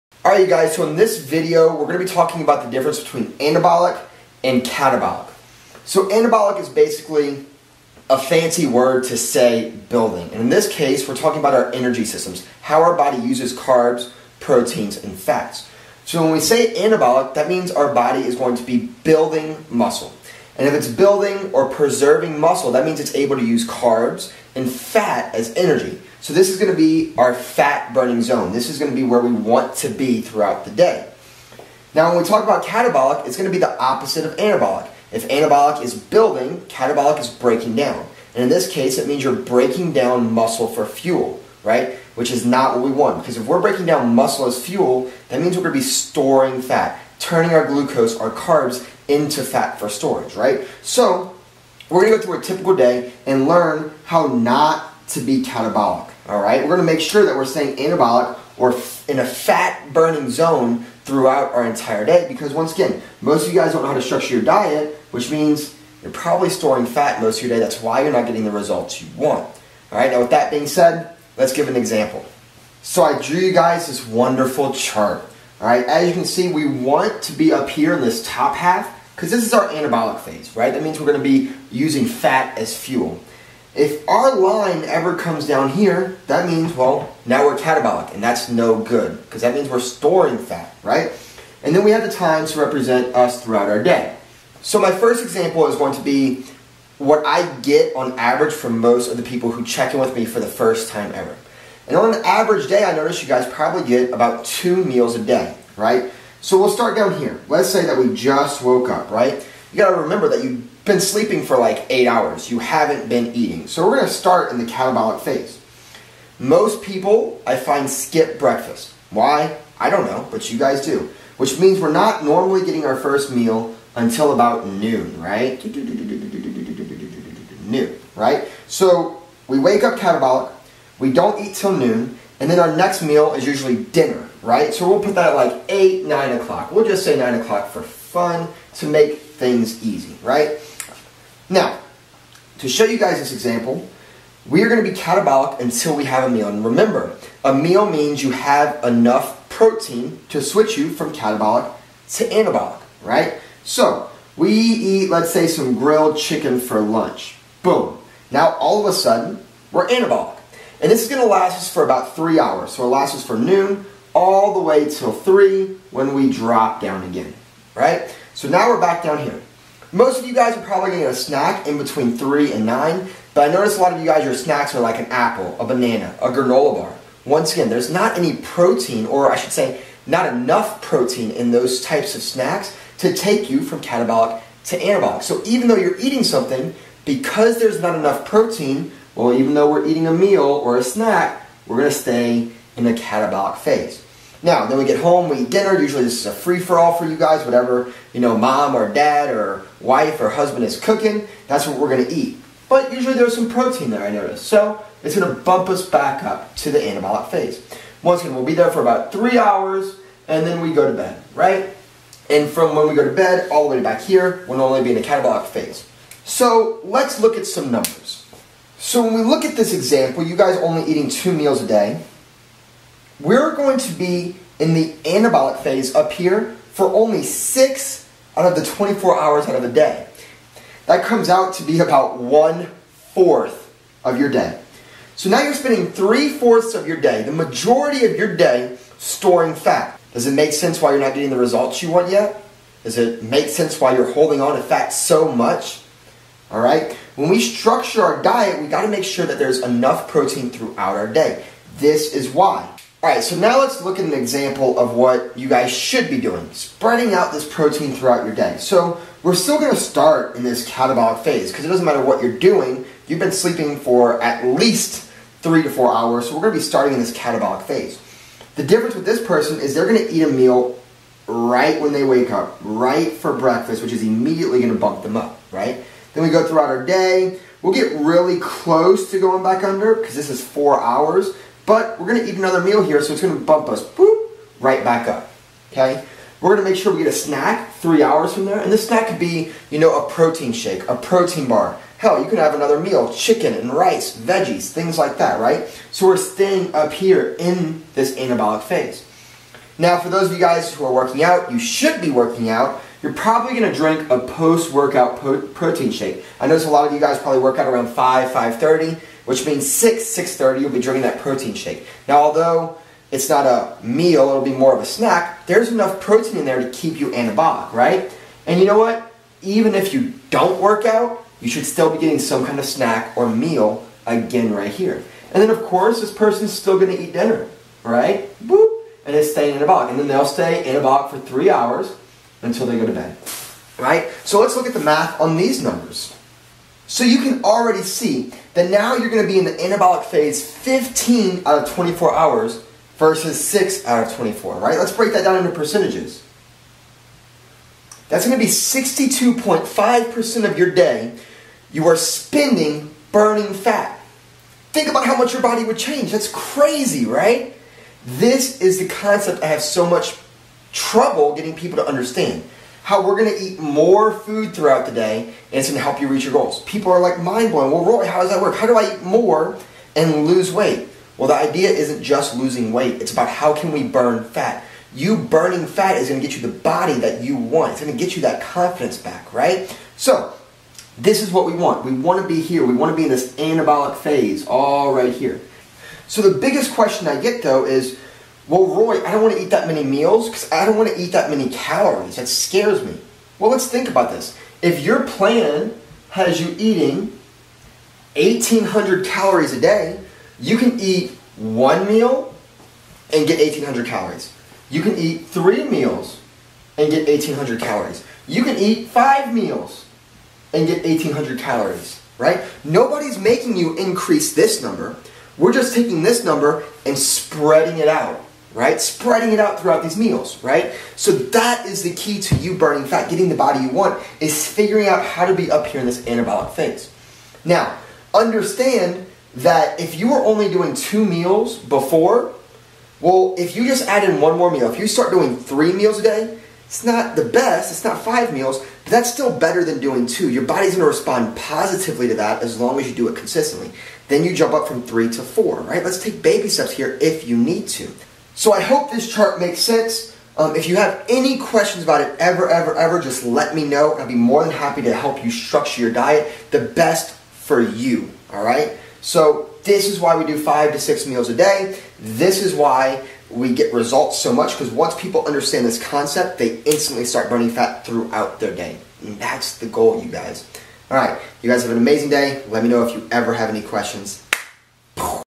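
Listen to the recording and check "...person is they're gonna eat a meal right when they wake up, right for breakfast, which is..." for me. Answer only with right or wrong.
right.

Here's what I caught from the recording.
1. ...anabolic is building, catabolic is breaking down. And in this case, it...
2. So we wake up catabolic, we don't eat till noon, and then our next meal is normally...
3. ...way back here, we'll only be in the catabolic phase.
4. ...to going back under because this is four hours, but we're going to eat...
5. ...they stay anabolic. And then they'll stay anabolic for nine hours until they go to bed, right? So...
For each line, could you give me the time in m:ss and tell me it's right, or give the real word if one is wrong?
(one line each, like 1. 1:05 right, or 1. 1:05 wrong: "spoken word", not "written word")
1. 0:35 right
2. 2:08 wrong: "usually", not "normally"
3. 3:33 right
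4. 4:39 right
5. 5:29 wrong: "three", not "nine".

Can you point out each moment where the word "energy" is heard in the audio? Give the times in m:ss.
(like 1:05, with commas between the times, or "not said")
0:11, 0:25.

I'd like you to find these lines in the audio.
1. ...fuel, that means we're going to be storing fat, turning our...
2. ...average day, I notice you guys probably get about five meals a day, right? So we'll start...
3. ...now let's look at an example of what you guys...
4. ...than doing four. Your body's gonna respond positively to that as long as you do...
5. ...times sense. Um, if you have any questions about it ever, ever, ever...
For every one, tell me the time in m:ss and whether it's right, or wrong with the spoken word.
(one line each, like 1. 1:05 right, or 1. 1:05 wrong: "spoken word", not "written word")
1. 0:44 right
2. 1:42 wrong: "two", not "five"
3. 4:13 right
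4. 7:19 wrong: "two", not "four"
5. 7:29 wrong: "makes", not "times".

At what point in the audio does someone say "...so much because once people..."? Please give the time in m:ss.
7:44.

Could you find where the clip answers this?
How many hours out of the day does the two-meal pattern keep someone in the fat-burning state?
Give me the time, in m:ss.
3:47.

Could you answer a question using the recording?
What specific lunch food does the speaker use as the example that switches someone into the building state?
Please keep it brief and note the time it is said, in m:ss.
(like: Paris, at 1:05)
grilled chicken, at 2:35.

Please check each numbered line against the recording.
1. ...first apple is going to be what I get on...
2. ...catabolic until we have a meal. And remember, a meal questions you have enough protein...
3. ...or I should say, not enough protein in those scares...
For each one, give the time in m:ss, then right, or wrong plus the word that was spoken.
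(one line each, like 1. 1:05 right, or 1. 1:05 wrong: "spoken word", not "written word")
1. 1:34 wrong: "example", not "apple"
2. 2:24 wrong: "means", not "questions"
3. 2:59 wrong: "types", not "scares".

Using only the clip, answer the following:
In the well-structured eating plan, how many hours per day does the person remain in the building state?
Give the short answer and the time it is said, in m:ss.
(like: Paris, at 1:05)
15, at 5:40.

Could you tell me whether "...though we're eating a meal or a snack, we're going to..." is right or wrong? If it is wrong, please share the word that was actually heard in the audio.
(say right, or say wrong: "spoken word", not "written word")
right.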